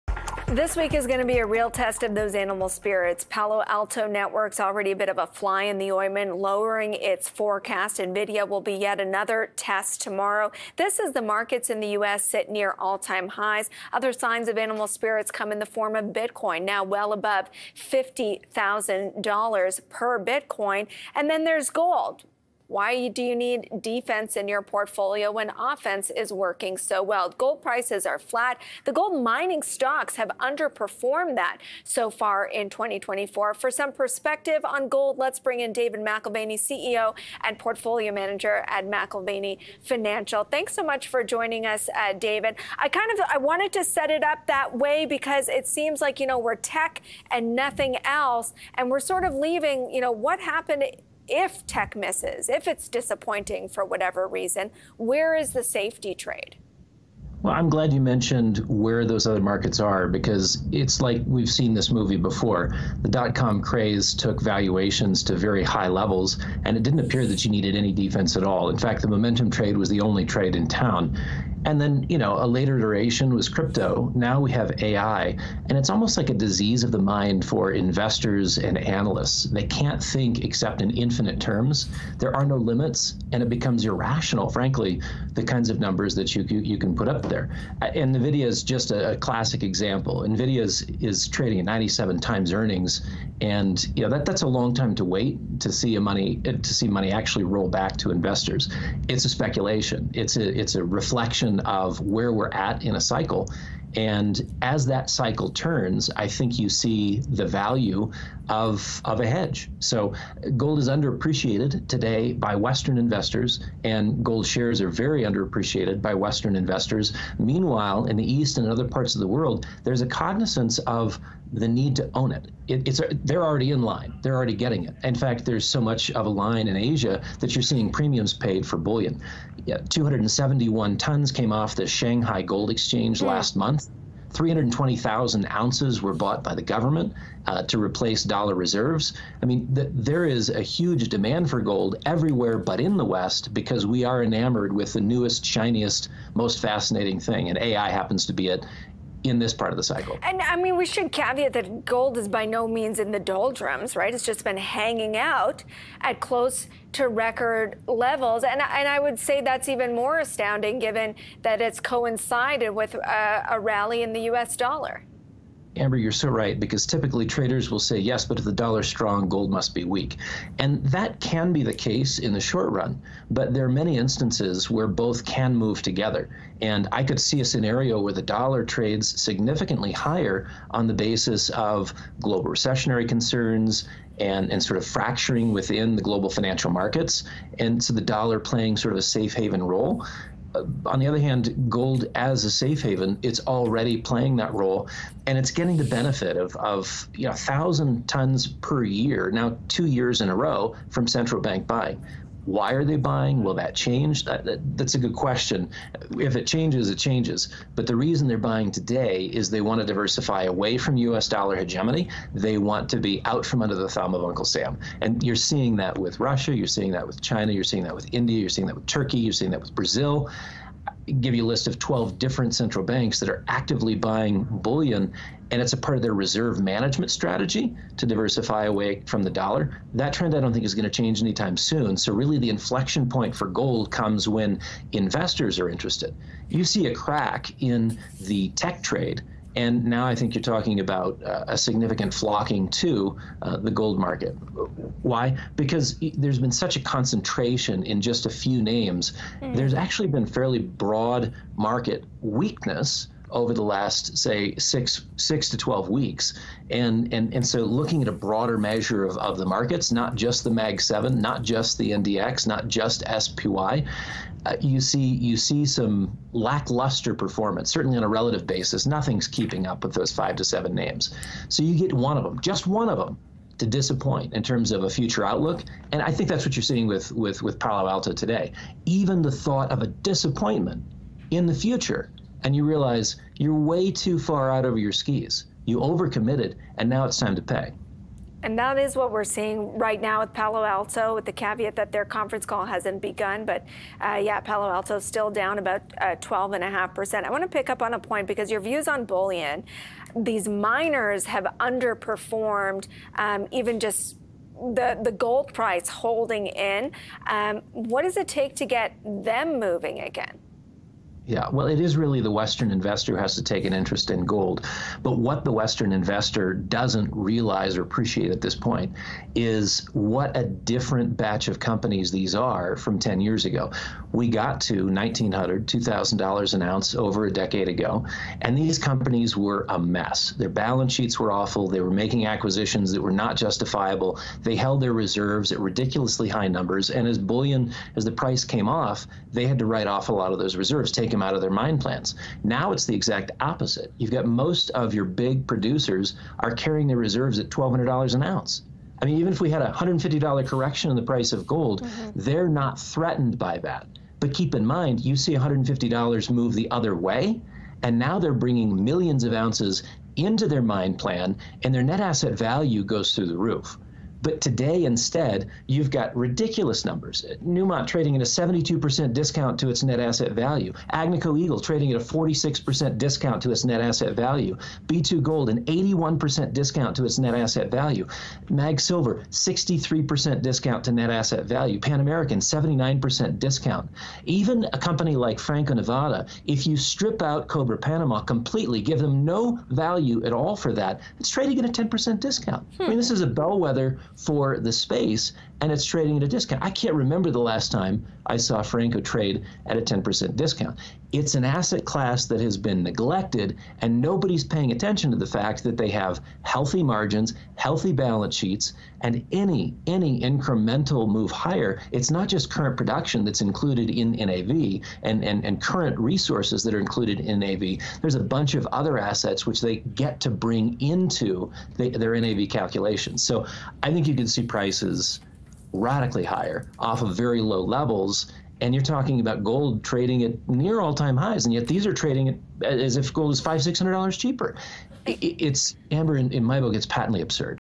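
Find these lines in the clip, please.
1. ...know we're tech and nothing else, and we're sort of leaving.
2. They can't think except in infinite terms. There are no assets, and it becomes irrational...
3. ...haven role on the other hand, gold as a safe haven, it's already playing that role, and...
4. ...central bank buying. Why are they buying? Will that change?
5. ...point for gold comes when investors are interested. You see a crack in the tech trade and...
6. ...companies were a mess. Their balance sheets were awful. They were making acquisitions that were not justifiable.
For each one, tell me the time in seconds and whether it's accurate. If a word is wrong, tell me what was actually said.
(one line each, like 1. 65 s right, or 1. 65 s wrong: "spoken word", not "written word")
1. 46 s right
2. 79 s wrong: "limits", not "assets"
3. 189 s right
4. 201 s right
5. 233 s right
6. 328 s right.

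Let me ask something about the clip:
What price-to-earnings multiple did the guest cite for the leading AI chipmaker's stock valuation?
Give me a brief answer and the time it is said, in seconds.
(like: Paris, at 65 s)
97 times earnings, at 91 s.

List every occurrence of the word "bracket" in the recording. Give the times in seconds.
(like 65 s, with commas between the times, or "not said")
not said.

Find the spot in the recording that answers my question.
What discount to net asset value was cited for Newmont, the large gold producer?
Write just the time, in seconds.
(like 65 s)
368 s.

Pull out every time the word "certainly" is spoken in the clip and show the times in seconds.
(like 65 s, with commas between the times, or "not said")
267 s.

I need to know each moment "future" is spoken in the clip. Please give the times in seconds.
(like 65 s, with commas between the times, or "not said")
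274 s, 281 s.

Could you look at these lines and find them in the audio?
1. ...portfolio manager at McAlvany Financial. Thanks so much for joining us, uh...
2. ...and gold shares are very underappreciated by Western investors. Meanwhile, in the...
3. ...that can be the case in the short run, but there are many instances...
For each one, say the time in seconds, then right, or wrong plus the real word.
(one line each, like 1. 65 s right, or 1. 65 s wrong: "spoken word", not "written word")
1. 37 s right
2. 113 s right
3. 170 s right.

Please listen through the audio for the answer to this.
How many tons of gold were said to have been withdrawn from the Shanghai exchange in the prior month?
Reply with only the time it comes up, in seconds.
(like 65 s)
129 s.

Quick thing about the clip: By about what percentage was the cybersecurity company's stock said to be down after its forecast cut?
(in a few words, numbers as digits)
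12.5%.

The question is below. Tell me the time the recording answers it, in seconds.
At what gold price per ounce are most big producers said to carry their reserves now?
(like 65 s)
347 s.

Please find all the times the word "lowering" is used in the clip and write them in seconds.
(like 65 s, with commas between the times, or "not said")
6 s.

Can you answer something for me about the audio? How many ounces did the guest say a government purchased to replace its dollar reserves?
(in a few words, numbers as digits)
320,000 ounces.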